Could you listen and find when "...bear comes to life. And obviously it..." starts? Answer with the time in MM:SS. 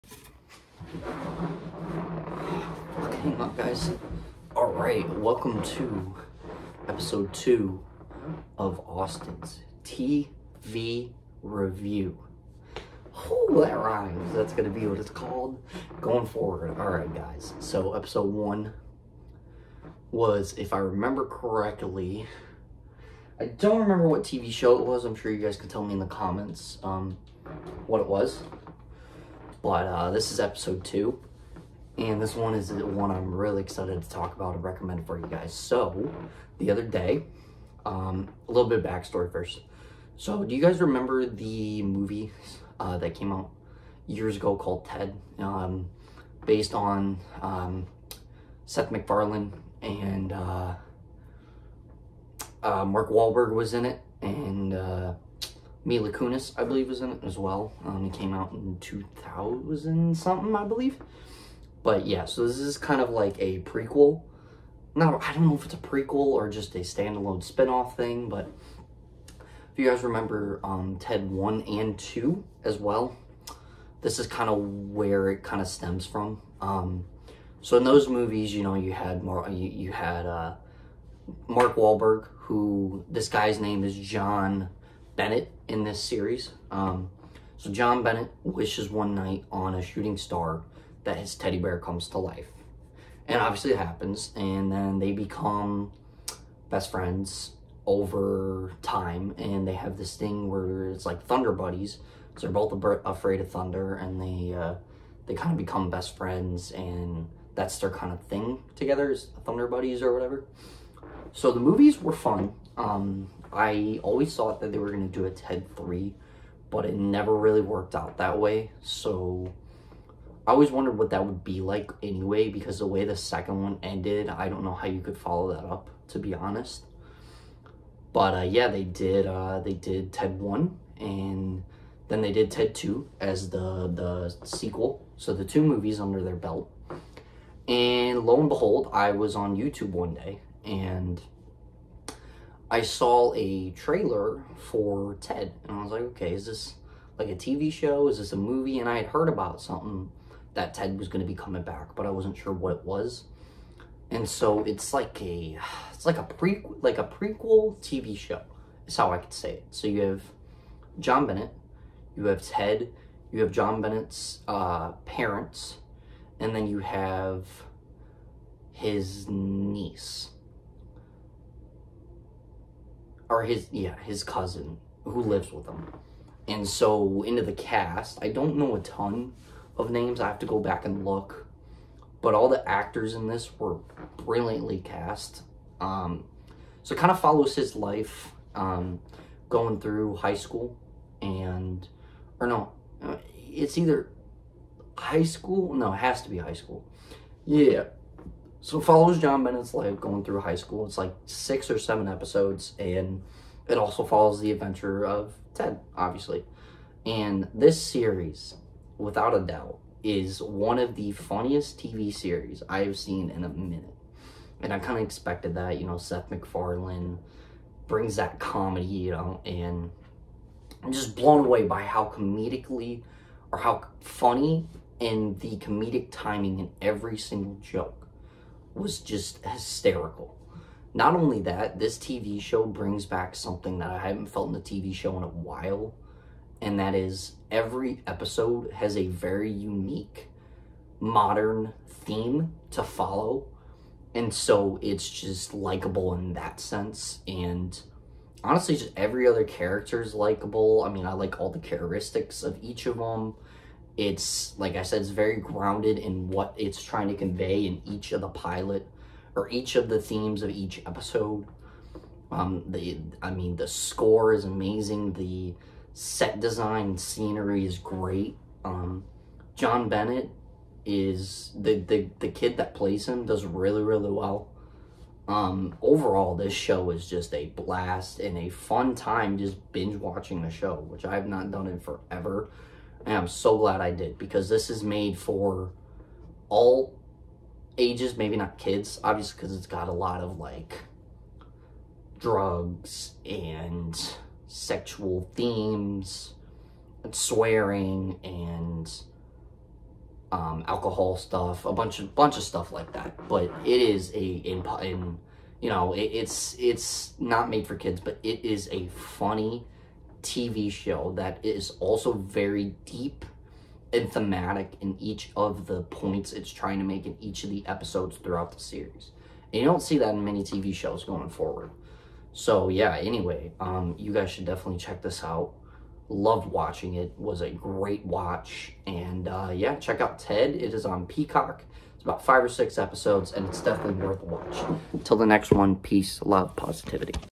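01:31.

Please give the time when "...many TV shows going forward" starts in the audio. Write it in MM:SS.
05:20.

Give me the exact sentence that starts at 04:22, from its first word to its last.
Um, the, I mean, the score is amazing.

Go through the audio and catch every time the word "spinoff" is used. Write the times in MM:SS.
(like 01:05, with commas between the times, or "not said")
01:07.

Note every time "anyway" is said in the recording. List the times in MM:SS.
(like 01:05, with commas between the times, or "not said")
02:02, 05:22.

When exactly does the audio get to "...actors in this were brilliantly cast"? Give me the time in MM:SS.
03:02.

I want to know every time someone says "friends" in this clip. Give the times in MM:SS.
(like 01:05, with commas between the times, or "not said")
01:36, 01:46.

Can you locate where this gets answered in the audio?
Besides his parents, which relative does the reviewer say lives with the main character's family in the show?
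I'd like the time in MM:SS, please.
02:54.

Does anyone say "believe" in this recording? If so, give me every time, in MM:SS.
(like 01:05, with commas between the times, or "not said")
00:56, 01:00.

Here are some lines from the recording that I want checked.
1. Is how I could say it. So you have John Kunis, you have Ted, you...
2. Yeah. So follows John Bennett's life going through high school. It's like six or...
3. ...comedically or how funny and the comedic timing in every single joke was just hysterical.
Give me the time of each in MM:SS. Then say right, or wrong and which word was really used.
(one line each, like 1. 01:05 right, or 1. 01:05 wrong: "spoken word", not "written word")
1. 02:38 wrong: "Bennett", not "Kunis"
2. 03:17 right
3. 03:42 right.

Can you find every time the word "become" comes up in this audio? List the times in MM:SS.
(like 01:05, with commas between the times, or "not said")
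01:35, 01:45.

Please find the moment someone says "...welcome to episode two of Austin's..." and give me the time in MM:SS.
00:05.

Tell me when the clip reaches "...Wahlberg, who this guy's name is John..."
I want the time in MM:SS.
01:21.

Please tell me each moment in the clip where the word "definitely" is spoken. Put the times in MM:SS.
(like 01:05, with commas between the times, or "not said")
05:24, 05:33.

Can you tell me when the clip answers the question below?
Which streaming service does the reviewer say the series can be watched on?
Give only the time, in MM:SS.
05:31.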